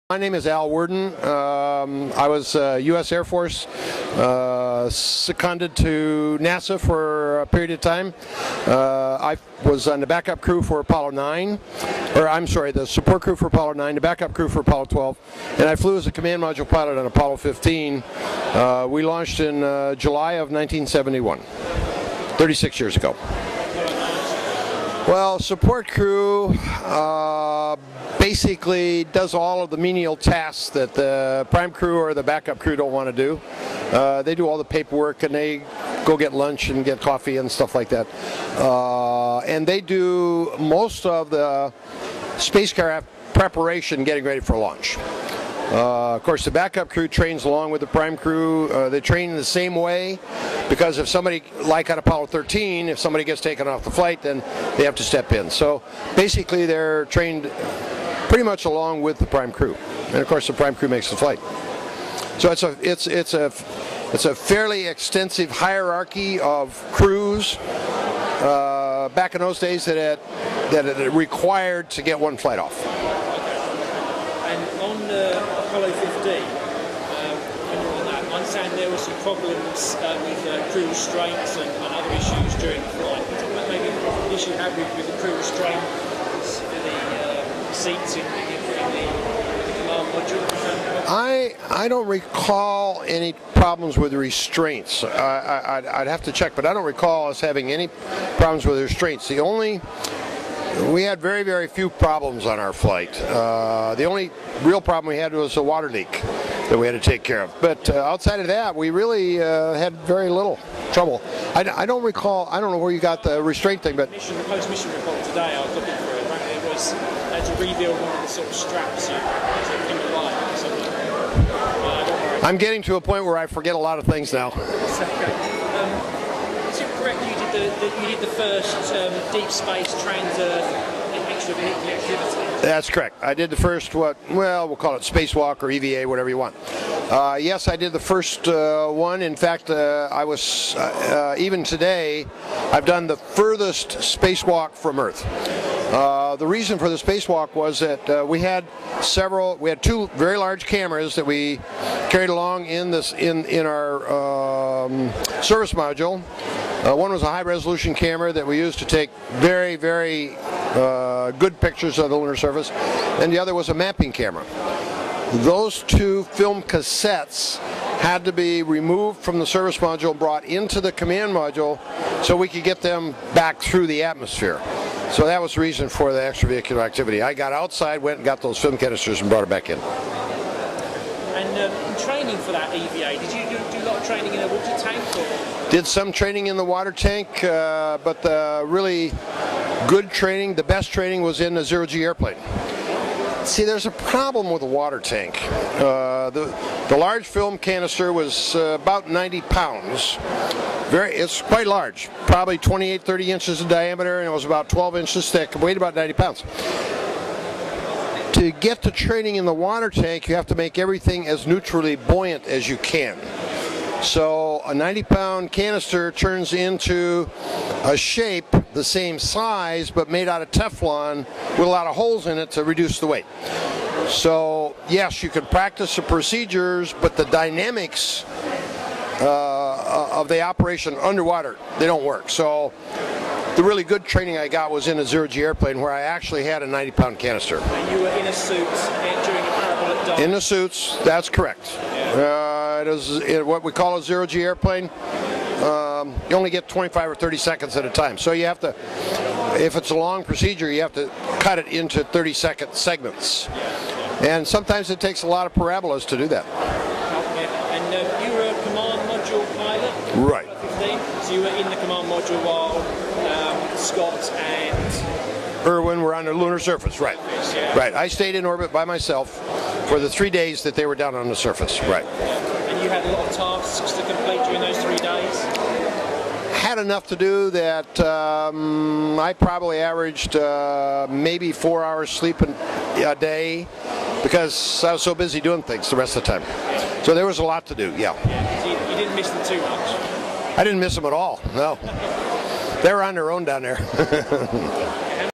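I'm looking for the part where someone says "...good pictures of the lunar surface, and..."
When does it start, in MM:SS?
02:41.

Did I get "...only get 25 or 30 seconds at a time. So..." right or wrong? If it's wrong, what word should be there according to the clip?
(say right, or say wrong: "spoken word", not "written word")
right.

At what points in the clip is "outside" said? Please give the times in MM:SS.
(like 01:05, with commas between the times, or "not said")
01:48, 02:57.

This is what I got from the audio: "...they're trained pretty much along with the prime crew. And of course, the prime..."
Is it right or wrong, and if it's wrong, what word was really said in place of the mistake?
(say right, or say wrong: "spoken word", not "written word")
right.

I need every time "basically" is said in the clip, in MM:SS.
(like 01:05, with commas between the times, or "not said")
00:28, 00:56.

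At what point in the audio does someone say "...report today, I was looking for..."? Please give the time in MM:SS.
01:54.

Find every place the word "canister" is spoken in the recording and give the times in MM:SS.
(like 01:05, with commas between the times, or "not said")
02:58, 03:17, 03:35, 03:57.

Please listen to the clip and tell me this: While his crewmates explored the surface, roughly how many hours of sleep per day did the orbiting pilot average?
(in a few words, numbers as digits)
4 hours.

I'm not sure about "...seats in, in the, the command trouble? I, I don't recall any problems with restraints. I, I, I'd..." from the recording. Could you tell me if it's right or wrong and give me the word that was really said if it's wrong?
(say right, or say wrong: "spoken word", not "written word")
wrong: "module", not "trouble".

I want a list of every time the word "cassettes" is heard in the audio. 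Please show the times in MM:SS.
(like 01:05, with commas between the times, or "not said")
02:46.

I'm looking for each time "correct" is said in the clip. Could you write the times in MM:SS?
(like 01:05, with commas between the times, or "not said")
02:06, 02:12, 04:01.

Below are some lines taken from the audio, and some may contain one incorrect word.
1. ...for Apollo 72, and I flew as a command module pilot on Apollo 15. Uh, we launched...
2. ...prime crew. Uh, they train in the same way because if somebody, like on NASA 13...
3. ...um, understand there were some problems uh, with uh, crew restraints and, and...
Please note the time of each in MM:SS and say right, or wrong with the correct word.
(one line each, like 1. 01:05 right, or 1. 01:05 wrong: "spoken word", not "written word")
1. 00:14 wrong: "12", not "72"
2. 00:47 wrong: "Apollo", not "NASA"
3. 01:18 right.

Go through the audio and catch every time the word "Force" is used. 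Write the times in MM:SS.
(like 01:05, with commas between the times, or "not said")
00:03.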